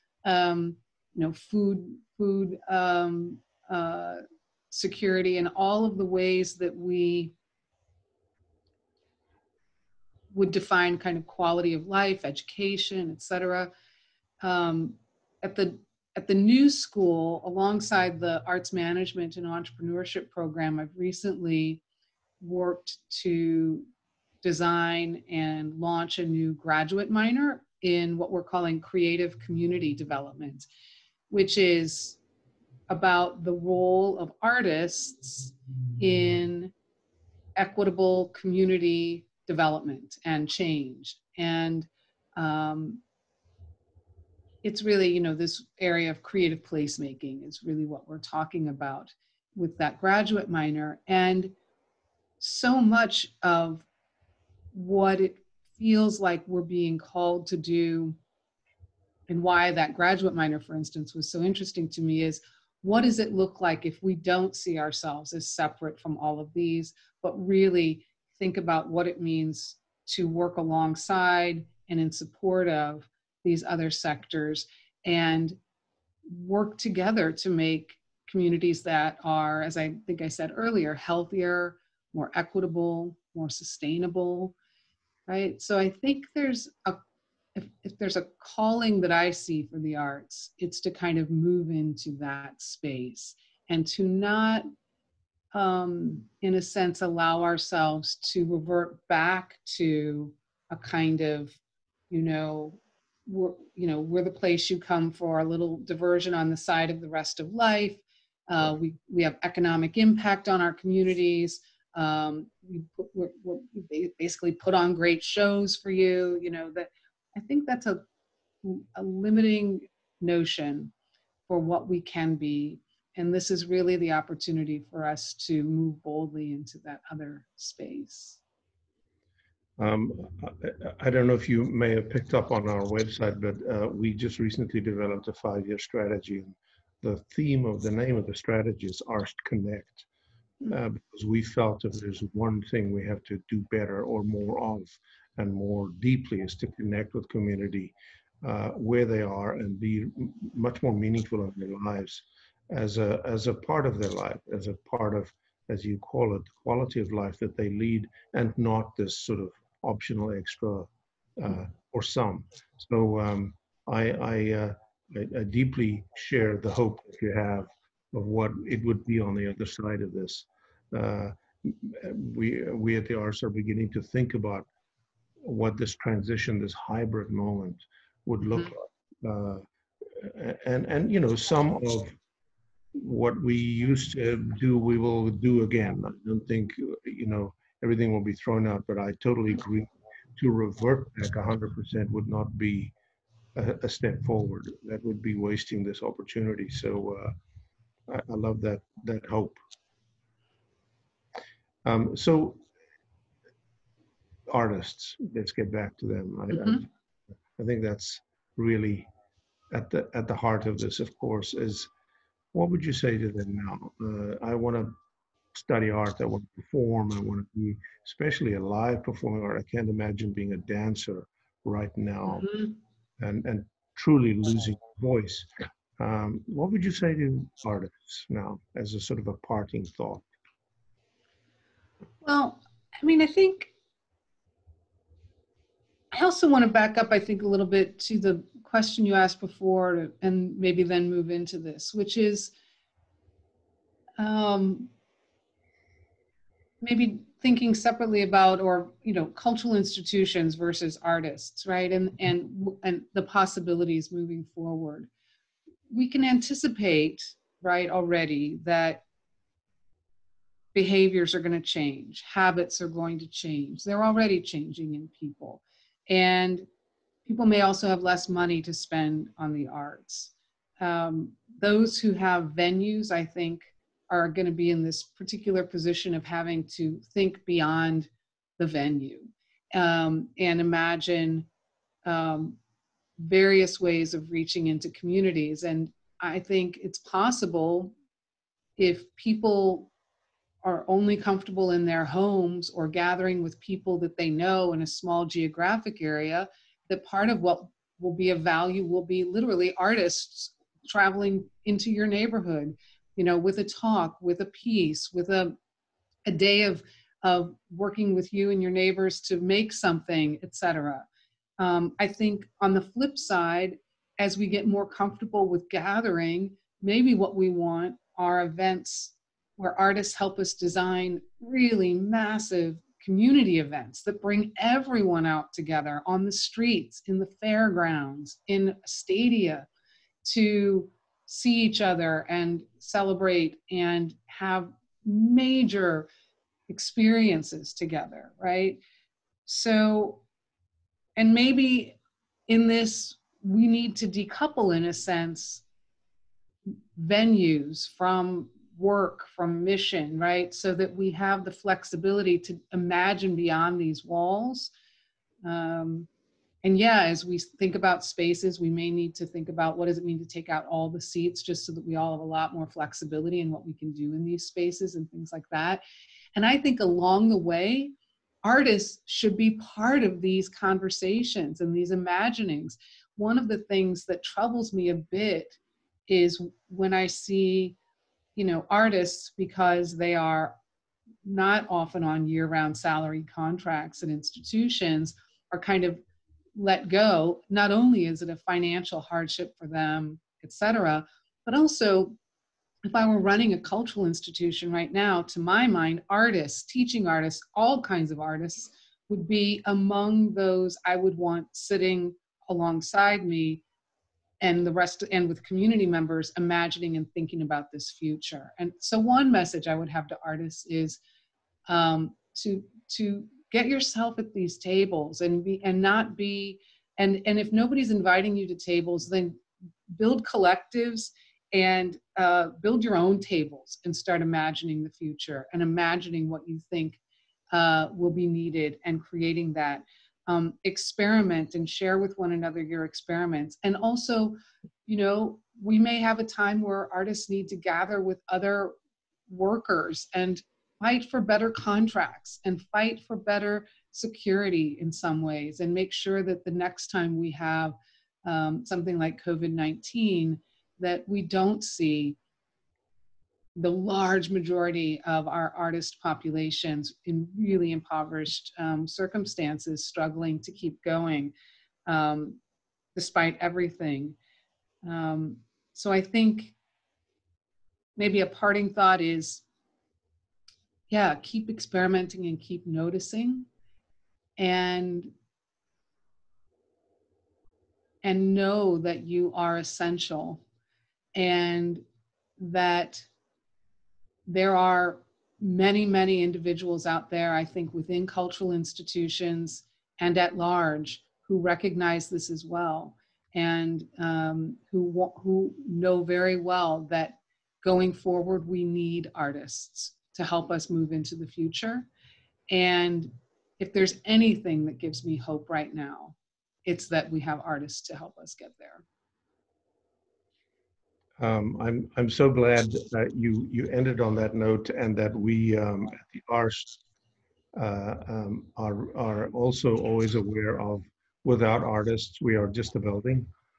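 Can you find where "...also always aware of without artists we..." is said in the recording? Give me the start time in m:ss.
8:39.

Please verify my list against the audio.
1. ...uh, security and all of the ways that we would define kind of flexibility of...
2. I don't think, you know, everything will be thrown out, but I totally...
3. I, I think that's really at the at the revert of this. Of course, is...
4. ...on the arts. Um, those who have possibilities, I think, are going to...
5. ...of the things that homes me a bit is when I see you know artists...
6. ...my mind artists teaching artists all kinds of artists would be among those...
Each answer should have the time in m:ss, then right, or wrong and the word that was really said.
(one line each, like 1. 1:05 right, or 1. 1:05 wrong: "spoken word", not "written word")
1. 0:03 wrong: "quality", not "flexibility"
2. 3:06 right
3. 3:27 wrong: "heart", not "revert"
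4. 4:29 wrong: "venues", not "possibilities"
5. 6:13 wrong: "troubles", not "homes"
6. 6:35 right.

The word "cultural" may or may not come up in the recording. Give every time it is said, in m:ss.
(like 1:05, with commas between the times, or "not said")
4:09, 6:33, 8:08.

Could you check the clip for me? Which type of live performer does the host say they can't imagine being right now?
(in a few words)
Dancer.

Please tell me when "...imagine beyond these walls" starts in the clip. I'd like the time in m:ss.
5:52.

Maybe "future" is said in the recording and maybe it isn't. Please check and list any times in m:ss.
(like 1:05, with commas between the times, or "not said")
6:47, 7:04, 8:21.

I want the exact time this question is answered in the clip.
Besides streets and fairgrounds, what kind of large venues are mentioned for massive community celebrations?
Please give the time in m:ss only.
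5:28.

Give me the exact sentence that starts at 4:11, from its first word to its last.
And and and the possibilities moving forward.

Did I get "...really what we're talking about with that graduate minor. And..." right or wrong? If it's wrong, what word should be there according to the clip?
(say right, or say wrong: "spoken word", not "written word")
right.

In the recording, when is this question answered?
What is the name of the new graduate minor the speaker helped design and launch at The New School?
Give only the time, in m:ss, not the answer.
0:28.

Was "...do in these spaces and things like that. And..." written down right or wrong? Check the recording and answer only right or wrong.
right.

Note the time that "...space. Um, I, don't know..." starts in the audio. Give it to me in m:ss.
2:07.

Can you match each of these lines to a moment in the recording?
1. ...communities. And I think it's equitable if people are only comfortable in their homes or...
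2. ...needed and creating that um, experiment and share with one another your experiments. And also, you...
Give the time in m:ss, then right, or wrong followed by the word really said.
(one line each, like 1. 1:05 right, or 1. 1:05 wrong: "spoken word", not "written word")
1. 4:44 wrong: "possible", not "equitable"
2. 7:08 right.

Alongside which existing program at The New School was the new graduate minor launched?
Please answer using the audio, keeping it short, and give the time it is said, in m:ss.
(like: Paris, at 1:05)
Arts management and entrepreneurship, at 0:18.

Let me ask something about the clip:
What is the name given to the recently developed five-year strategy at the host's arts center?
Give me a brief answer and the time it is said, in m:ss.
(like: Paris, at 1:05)
Arsht Connect, at 2:19.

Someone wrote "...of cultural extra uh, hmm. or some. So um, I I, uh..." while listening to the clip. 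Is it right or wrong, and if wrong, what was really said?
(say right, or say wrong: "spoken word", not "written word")
wrong: "optional", not "cultural".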